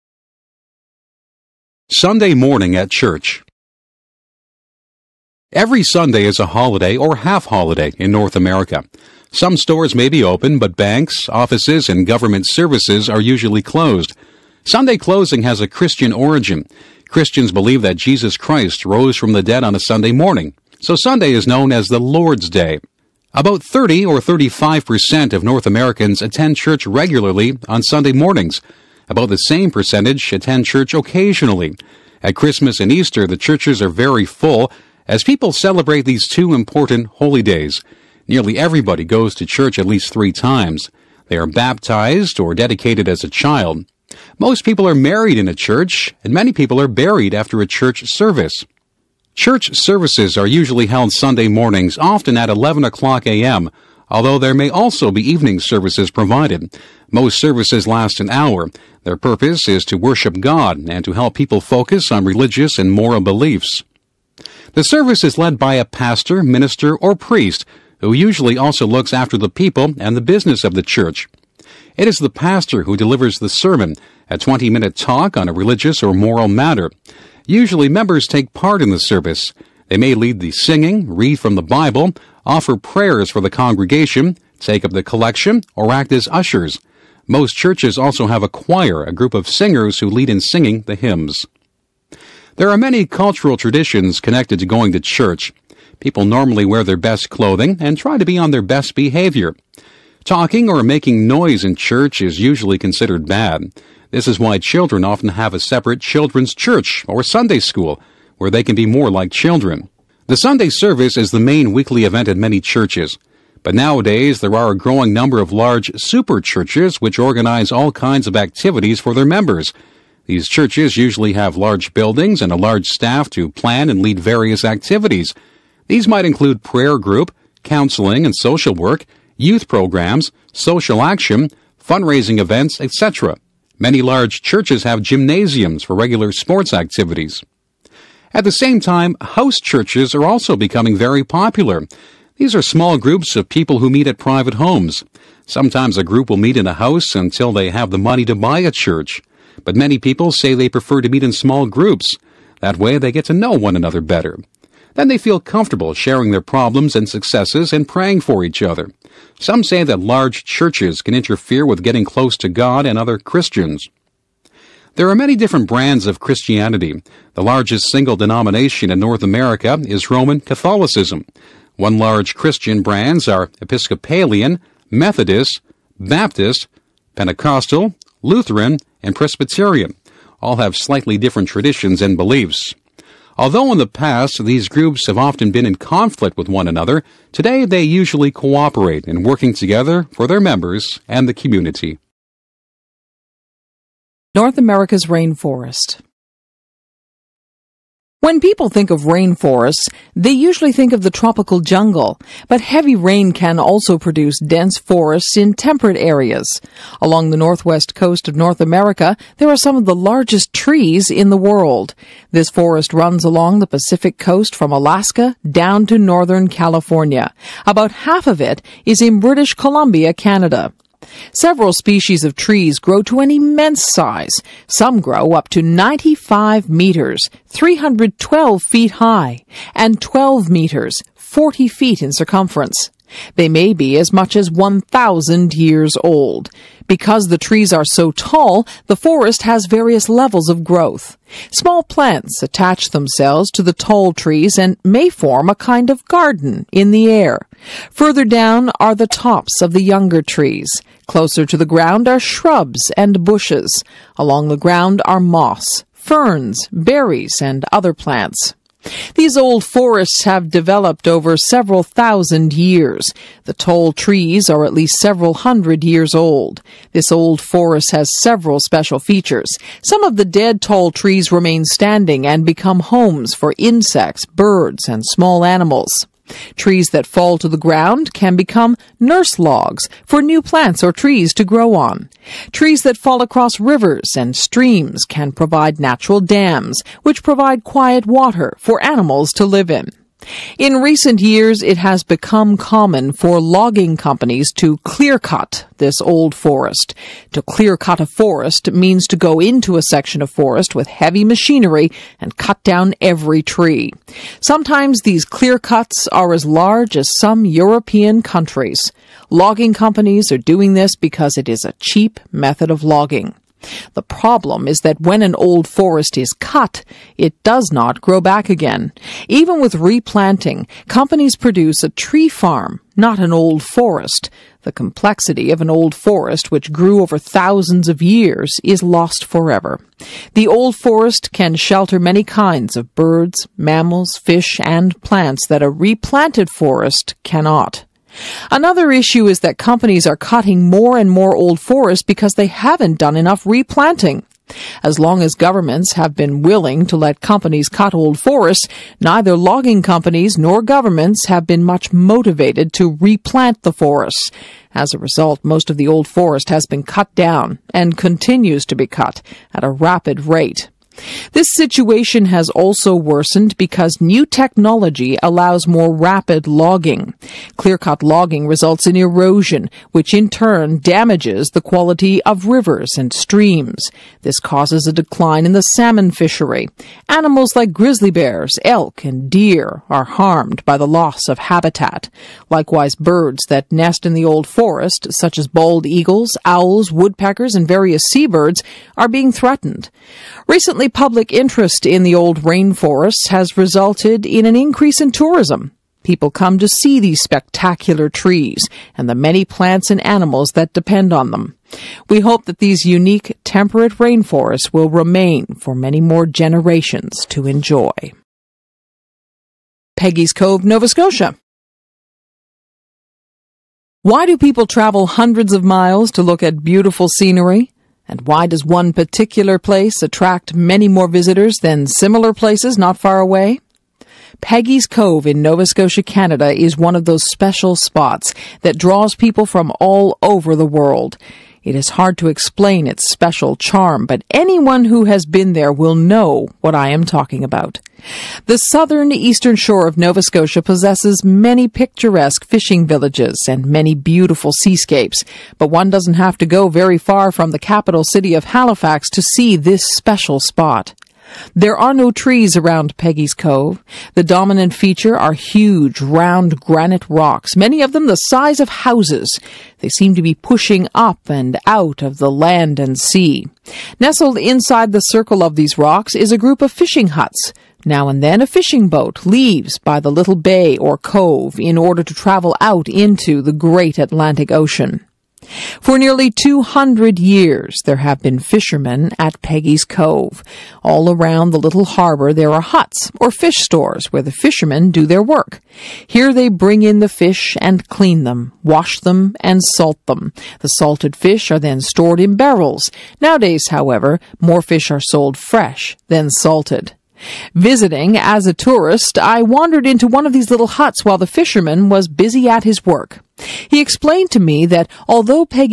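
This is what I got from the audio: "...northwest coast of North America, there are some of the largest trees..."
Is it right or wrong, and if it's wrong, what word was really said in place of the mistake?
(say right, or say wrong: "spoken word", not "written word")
right.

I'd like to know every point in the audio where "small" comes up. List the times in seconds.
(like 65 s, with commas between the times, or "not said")
142 s, 151 s, 241 s, 275 s.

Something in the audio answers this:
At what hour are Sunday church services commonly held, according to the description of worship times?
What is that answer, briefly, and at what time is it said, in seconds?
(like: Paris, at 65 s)
11 o'clock, at 52 s.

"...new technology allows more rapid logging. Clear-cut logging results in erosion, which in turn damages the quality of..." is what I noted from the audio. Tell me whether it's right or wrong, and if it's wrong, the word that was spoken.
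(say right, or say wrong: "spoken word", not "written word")
right.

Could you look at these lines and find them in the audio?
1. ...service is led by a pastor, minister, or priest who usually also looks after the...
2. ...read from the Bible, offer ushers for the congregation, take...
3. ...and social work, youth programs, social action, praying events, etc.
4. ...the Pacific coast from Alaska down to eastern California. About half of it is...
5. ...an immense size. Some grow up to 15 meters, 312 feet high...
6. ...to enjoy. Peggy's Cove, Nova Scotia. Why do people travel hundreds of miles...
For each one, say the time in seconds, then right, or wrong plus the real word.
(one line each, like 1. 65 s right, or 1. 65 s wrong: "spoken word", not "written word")
1. 64 s right
2. 81 s wrong: "prayers", not "ushers"
3. 128 s wrong: "fundraising", not "praying"
4. 213 s wrong: "northern", not "eastern"
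5. 223 s wrong: "95", not "15"
6. 407 s right.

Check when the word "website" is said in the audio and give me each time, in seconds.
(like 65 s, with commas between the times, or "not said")
not said.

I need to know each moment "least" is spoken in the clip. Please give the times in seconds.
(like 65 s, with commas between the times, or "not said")
39 s, 264 s.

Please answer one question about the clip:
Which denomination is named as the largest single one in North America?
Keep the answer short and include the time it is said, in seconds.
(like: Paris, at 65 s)
Roman Catholicism, at 170 s.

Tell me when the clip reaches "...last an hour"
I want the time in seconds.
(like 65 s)
57 s.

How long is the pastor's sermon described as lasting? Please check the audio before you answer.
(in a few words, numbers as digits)
20 minutes.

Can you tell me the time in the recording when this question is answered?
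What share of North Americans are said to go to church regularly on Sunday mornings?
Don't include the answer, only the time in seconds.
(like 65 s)
23 s.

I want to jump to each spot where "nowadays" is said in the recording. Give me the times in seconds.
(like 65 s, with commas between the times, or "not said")
113 s, 493 s.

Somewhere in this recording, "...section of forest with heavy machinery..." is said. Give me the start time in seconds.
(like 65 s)
299 s.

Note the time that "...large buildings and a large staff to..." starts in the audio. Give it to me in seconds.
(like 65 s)
121 s.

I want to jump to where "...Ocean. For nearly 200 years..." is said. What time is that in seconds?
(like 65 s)
474 s.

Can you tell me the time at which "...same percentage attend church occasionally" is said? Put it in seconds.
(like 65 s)
29 s.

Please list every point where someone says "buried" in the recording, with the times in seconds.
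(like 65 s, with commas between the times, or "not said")
46 s.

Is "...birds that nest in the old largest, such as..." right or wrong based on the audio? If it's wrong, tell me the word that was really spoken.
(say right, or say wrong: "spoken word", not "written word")
wrong: "forest", not "largest".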